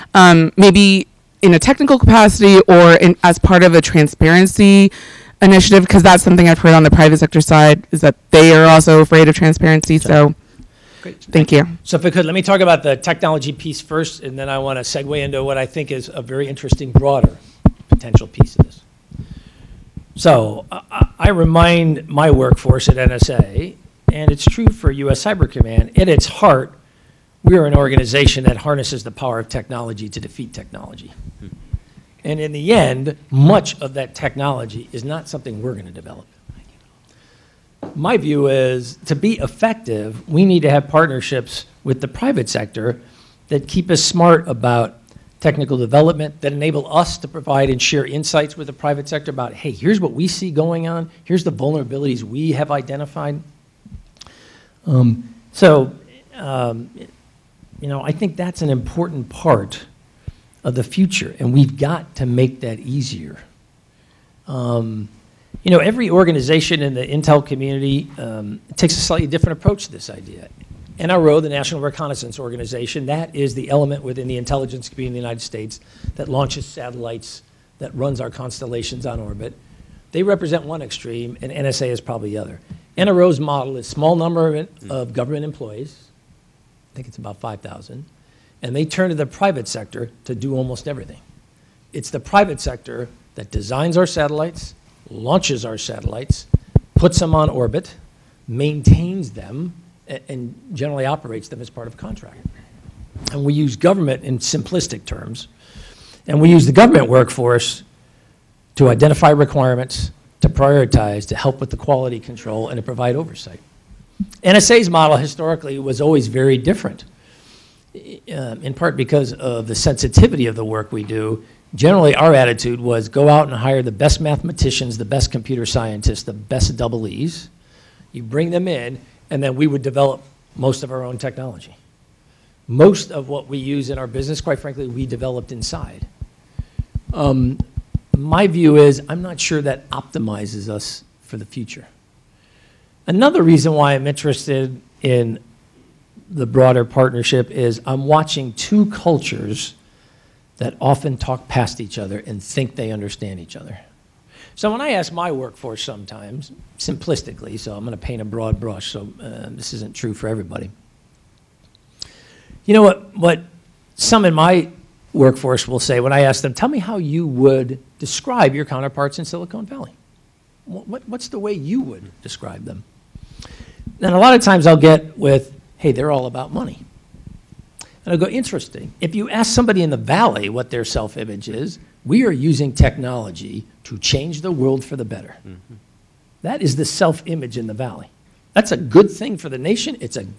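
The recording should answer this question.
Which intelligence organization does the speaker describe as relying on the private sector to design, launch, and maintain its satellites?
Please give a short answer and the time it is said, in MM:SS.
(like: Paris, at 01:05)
National Reconnaissance Organization, at 01:11.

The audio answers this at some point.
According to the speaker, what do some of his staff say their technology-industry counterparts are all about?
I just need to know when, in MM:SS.
02:56.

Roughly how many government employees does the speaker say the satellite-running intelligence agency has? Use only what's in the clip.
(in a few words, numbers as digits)
5,000.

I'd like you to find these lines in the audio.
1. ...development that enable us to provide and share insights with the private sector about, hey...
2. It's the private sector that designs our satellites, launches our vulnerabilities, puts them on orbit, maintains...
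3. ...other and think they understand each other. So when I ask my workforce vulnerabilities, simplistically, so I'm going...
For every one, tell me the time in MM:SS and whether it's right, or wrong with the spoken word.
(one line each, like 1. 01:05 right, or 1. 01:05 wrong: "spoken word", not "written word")
1. 00:45 right
2. 01:31 wrong: "satellites", not "vulnerabilities"
3. 02:31 wrong: "sometimes", not "vulnerabilities".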